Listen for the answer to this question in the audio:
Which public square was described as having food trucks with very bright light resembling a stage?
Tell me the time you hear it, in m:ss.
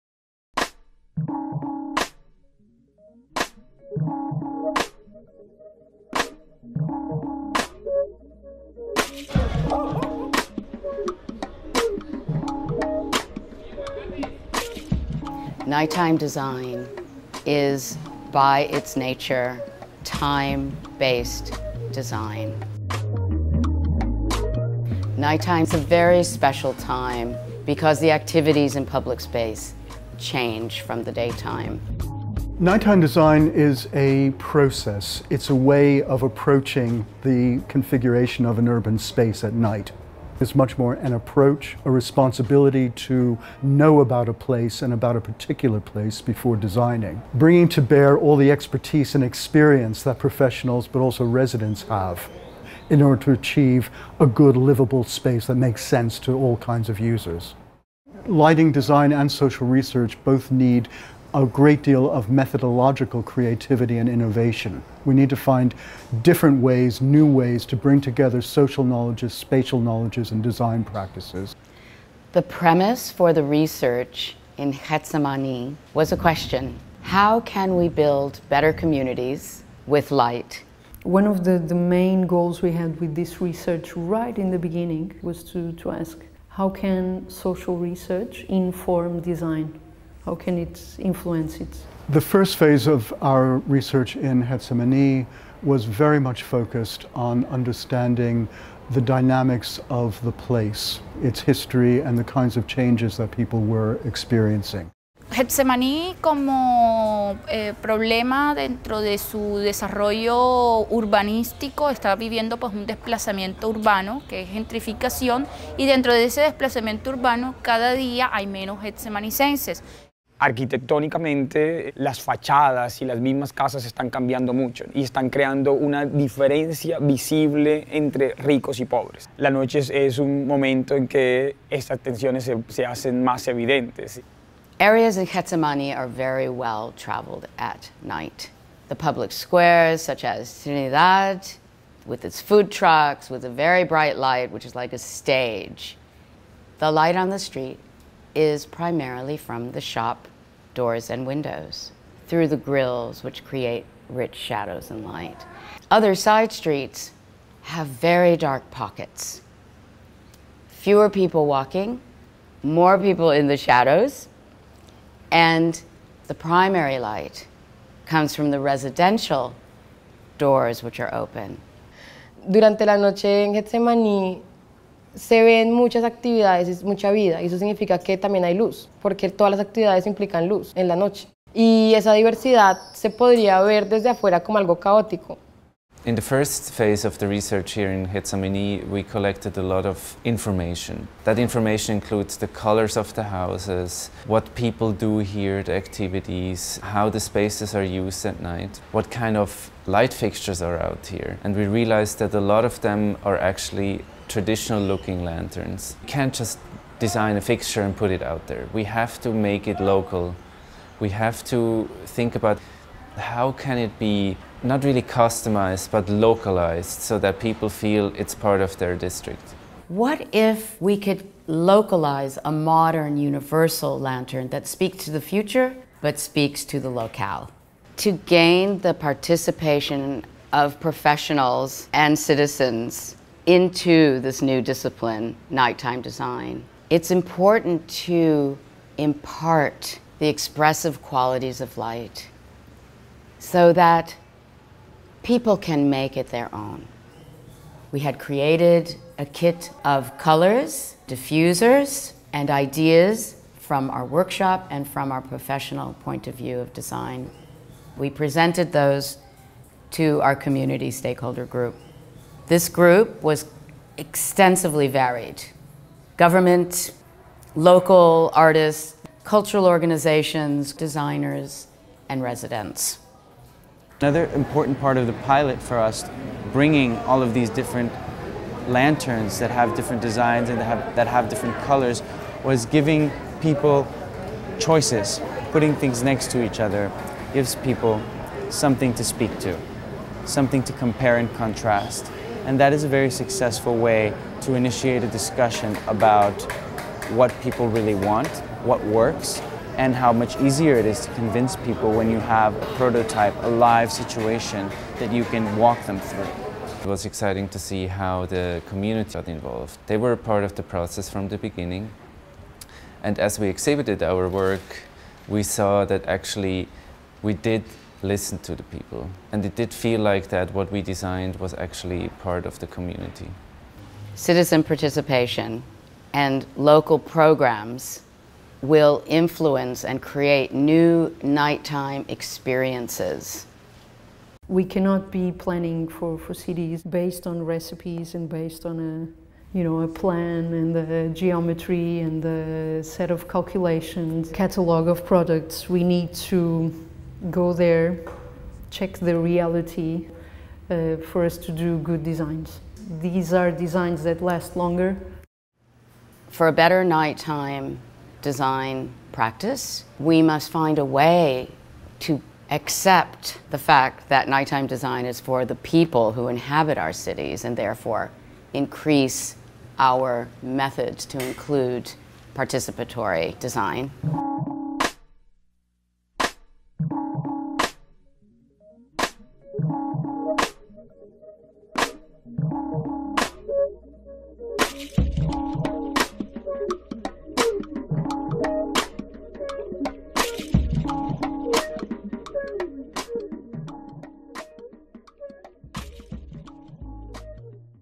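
2:20.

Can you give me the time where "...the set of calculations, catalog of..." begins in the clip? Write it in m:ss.
5:42.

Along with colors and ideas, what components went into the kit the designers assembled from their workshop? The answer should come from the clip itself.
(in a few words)
diffusers.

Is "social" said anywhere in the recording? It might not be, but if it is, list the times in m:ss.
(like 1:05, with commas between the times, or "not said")
0:59, 1:08, 1:27.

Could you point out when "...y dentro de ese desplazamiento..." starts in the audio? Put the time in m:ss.
1:55.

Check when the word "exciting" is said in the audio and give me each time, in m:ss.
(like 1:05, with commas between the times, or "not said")
5:07.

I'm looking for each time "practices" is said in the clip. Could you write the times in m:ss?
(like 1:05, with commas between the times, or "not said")
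1:10, 5:59.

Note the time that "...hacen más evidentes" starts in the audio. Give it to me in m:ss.
2:12.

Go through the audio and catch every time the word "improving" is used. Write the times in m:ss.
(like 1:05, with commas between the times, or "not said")
not said.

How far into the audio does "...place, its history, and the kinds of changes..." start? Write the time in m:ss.
1:40.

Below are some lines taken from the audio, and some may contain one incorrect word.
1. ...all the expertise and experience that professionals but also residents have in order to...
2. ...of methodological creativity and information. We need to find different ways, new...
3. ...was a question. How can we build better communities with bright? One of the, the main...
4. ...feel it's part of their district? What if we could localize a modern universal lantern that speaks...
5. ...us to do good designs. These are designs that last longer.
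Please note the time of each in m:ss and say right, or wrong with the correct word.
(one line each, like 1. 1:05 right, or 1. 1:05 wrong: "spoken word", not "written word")
1. 0:48 right
2. 1:02 wrong: "innovation", not "information"
3. 1:15 wrong: "light", not "bright"
4. 3:37 right
5. 5:51 right.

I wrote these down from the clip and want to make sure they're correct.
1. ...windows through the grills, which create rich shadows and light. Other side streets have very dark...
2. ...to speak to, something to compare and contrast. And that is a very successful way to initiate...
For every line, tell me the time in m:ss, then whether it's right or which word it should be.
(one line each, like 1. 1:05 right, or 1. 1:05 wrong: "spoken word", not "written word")
1. 2:31 right
2. 4:48 right.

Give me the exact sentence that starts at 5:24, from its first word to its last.
Citizen participation and local programs will influence and create new nighttime experiences.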